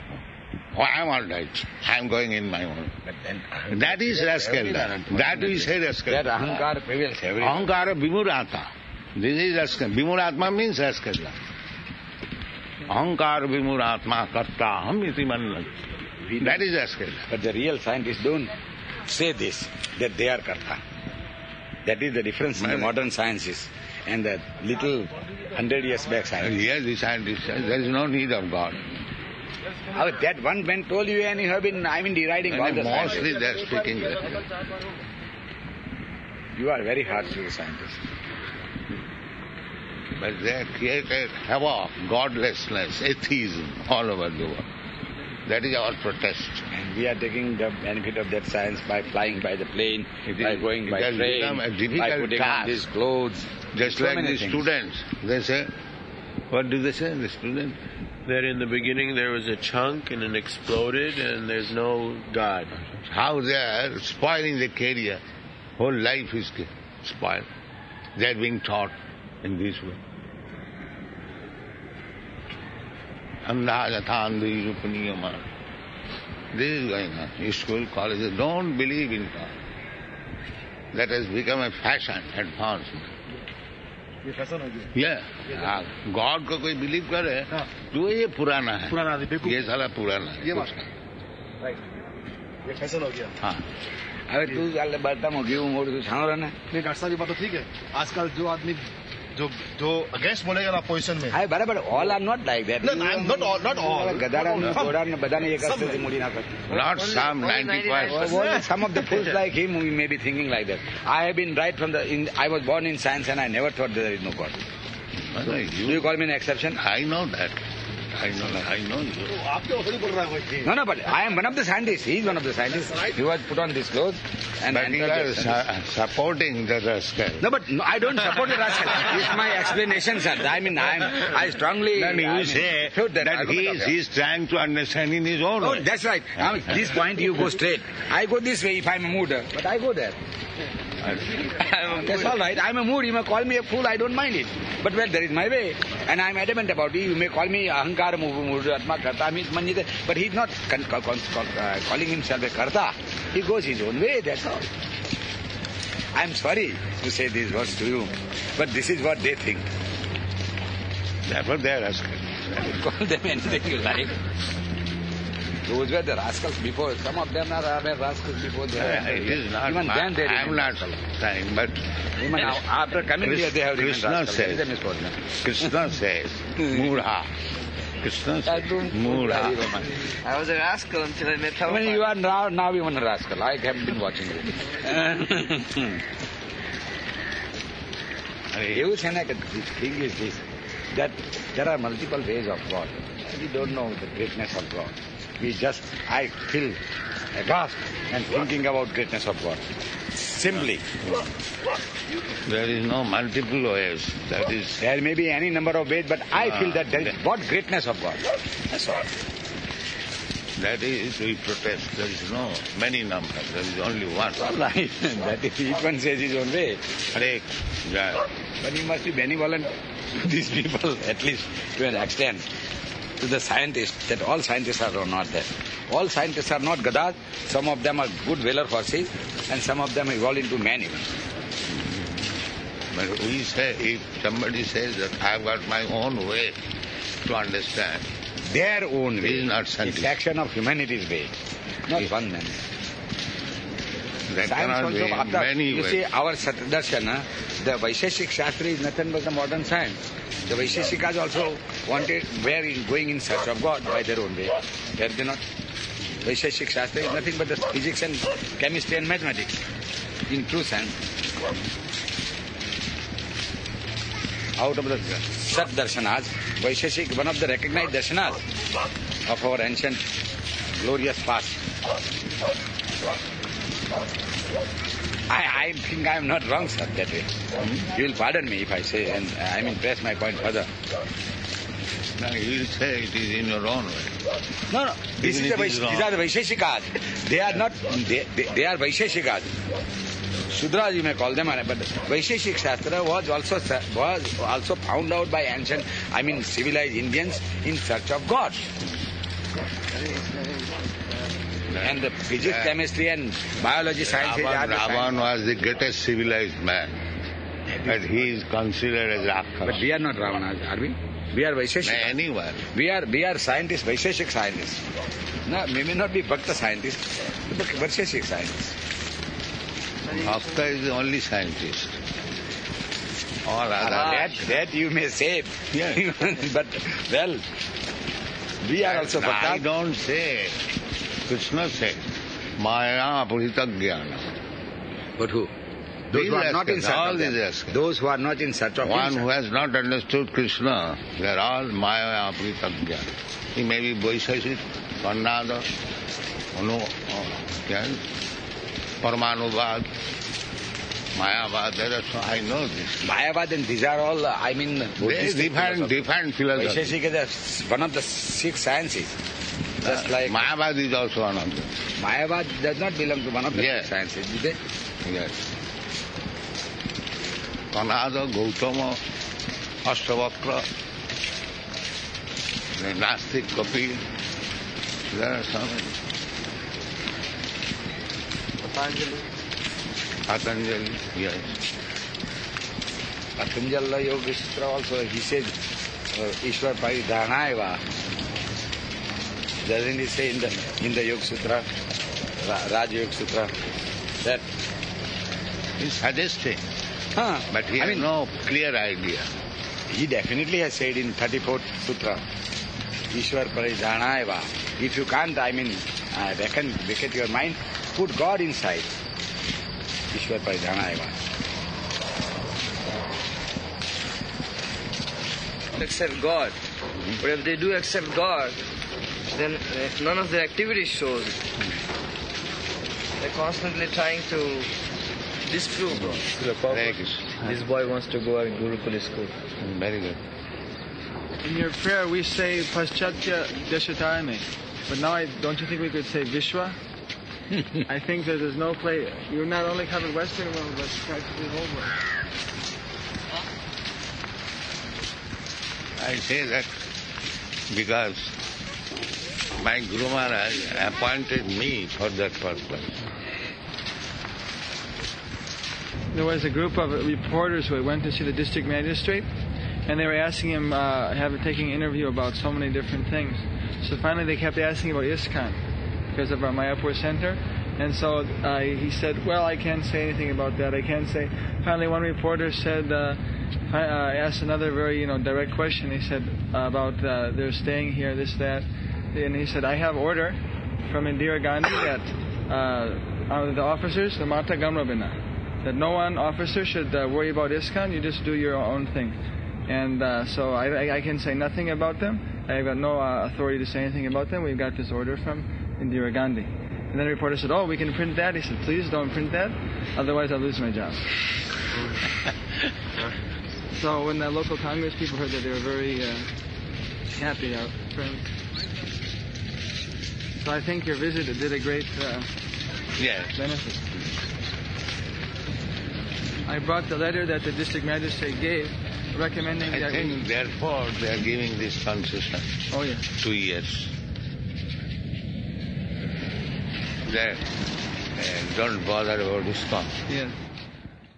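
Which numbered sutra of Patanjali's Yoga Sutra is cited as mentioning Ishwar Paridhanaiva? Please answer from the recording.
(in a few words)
34th.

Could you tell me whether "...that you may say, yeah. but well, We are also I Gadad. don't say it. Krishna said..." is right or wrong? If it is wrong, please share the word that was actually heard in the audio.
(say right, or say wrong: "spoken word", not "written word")
wrong: "Bhaktad", not "Gadad".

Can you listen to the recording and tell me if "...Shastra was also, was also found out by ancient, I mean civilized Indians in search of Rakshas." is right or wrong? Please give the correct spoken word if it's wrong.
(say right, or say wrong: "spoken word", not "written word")
wrong: "God", not "Rakshas".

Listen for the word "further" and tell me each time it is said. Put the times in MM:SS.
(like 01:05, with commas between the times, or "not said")
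04:40.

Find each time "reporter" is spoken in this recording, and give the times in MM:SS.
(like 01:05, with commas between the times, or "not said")
07:37, 07:52, 08:17.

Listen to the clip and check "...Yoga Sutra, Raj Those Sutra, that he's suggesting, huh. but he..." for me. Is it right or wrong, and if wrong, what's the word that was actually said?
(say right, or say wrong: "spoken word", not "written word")
wrong: "Yoga", not "Those".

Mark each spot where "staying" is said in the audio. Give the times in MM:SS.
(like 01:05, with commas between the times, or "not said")
07:57.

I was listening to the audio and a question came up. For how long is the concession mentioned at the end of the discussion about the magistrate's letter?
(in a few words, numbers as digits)
2 years.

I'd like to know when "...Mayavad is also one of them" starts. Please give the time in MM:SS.
06:00.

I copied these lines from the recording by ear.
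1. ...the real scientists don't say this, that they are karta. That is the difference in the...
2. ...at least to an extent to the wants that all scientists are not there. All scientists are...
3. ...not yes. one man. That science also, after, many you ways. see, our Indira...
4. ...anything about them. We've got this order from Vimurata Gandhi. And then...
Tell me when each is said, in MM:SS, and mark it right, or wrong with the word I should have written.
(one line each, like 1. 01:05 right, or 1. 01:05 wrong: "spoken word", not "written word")
1. 00:17 right
2. 03:41 wrong: "scientists", not "wants"
3. 04:01 wrong: "Darshana", not "Indira"
4. 08:13 wrong: "Indira", not "Vimurata".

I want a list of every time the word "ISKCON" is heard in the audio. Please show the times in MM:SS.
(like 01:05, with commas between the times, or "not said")
07:45, 08:07, 08:49.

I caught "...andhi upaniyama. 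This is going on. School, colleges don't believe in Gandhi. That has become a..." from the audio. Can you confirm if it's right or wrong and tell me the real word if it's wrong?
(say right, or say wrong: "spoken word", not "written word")
wrong: "God", not "Gandhi".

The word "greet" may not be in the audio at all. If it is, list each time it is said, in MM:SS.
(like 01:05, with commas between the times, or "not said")
not said.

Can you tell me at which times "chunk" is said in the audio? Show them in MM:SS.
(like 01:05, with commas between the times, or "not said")
00:59.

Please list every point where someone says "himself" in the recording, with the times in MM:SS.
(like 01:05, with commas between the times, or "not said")
02:32, 05:39.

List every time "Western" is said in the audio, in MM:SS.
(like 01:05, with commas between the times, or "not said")
07:20.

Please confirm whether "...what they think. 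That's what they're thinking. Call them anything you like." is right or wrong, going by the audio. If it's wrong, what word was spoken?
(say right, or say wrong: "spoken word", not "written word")
wrong: "asking", not "thinking".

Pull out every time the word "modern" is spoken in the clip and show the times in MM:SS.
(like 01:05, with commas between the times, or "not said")
00:22, 04:09.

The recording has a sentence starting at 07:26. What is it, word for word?
I say that because my Guru Maharaj appointed me for that purpose.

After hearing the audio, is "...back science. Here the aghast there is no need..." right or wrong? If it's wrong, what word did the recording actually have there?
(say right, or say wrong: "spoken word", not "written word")
wrong: "scientist", not "aghast".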